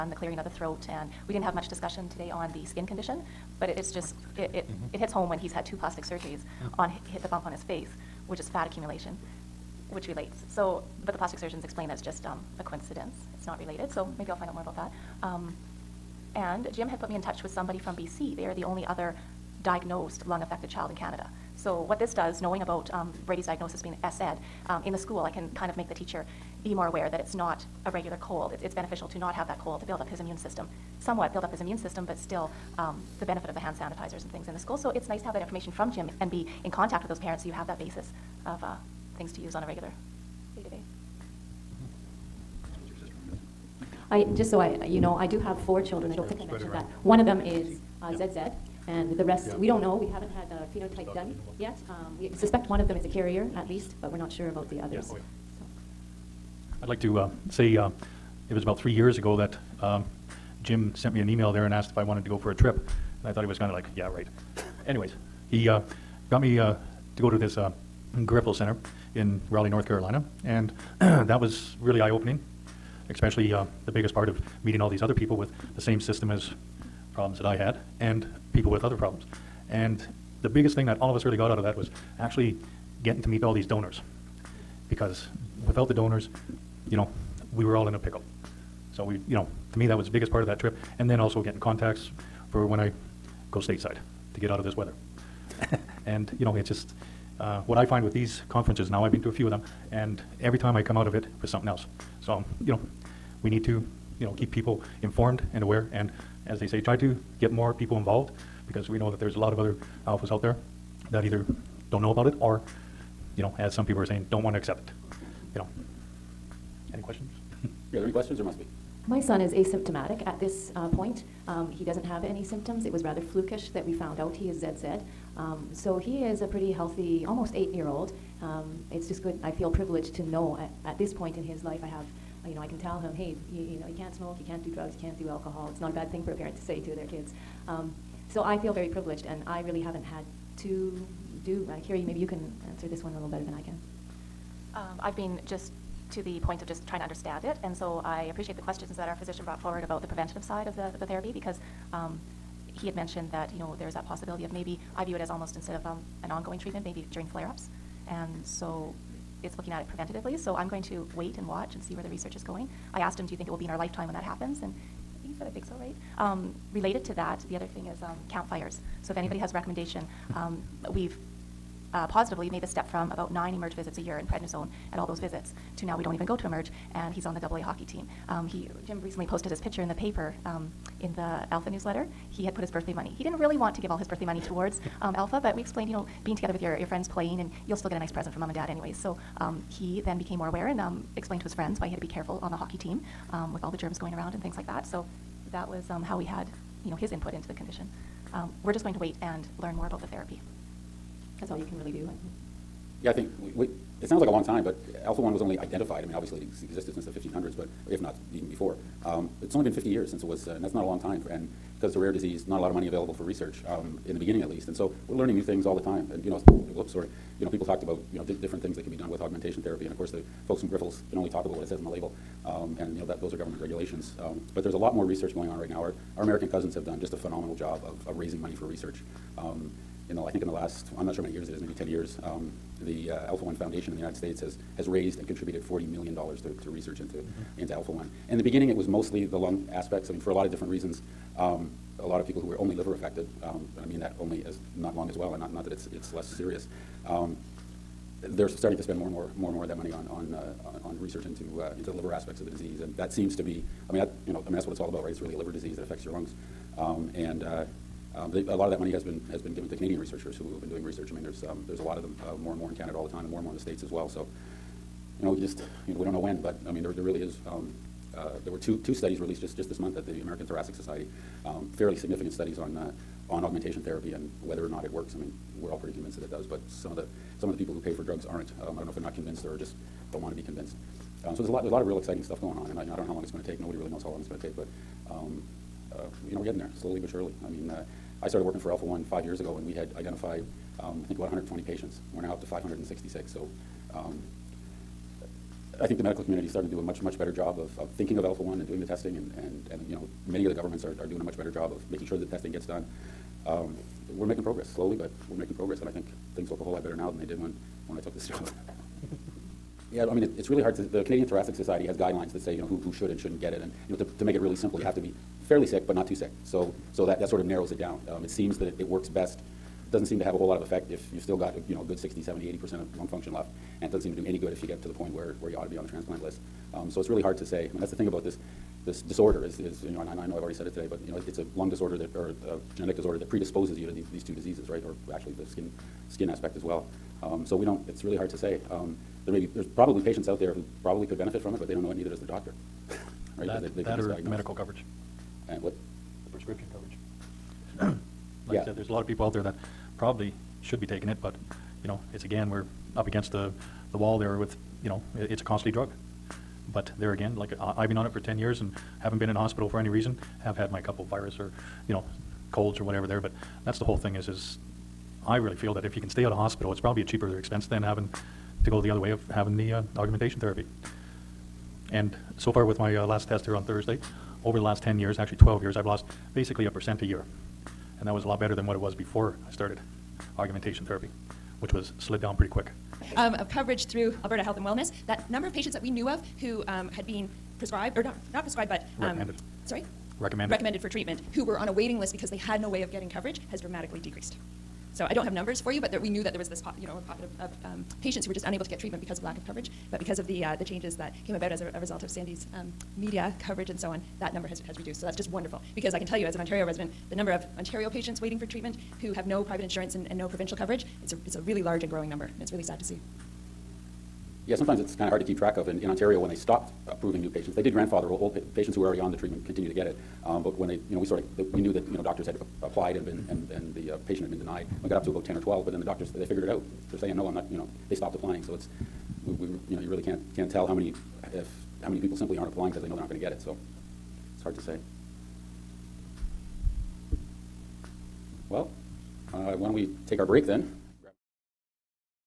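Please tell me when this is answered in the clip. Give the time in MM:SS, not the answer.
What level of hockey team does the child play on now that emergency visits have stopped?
02:57.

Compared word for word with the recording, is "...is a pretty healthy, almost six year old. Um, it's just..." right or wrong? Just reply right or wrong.
wrong.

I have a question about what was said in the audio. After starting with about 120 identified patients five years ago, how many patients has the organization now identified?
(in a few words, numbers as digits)
566.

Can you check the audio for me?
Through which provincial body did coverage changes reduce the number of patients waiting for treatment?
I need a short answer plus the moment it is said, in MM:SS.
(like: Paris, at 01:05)
Alberta Health and Wellness, at 06:24.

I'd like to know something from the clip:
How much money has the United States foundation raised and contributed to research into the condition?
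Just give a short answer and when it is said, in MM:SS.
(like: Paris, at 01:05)
$40 million, at 03:55.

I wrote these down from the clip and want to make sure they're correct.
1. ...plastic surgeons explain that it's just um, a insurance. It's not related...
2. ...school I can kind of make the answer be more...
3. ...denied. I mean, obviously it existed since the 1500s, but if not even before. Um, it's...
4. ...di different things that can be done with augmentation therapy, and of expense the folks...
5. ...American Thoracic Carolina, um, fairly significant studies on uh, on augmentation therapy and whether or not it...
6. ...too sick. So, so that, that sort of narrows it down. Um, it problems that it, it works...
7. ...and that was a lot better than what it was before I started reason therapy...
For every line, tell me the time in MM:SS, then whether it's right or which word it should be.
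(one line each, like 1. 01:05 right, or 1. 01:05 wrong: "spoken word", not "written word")
1. 00:11 wrong: "coincidence", not "insurance"
2. 00:24 wrong: "teacher", not "answer"
3. 03:25 wrong: "identified", not "denied"
4. 03:38 wrong: "course", not "expense"
5. 04:30 wrong: "Society", not "Carolina"
6. 05:16 wrong: "seems", not "problems"
7. 06:18 wrong: "argumentation", not "reason".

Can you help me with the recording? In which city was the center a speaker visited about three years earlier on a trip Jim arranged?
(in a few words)
Raleigh, North Carolina.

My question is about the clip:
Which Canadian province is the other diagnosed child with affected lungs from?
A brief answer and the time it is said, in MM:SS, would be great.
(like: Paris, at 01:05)
BC, at 00:17.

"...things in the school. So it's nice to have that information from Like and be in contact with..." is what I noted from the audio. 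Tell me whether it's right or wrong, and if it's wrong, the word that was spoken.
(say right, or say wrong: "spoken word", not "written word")
wrong: "Jim", not "Like".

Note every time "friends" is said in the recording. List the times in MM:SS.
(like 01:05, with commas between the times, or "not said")
03:06, 03:11.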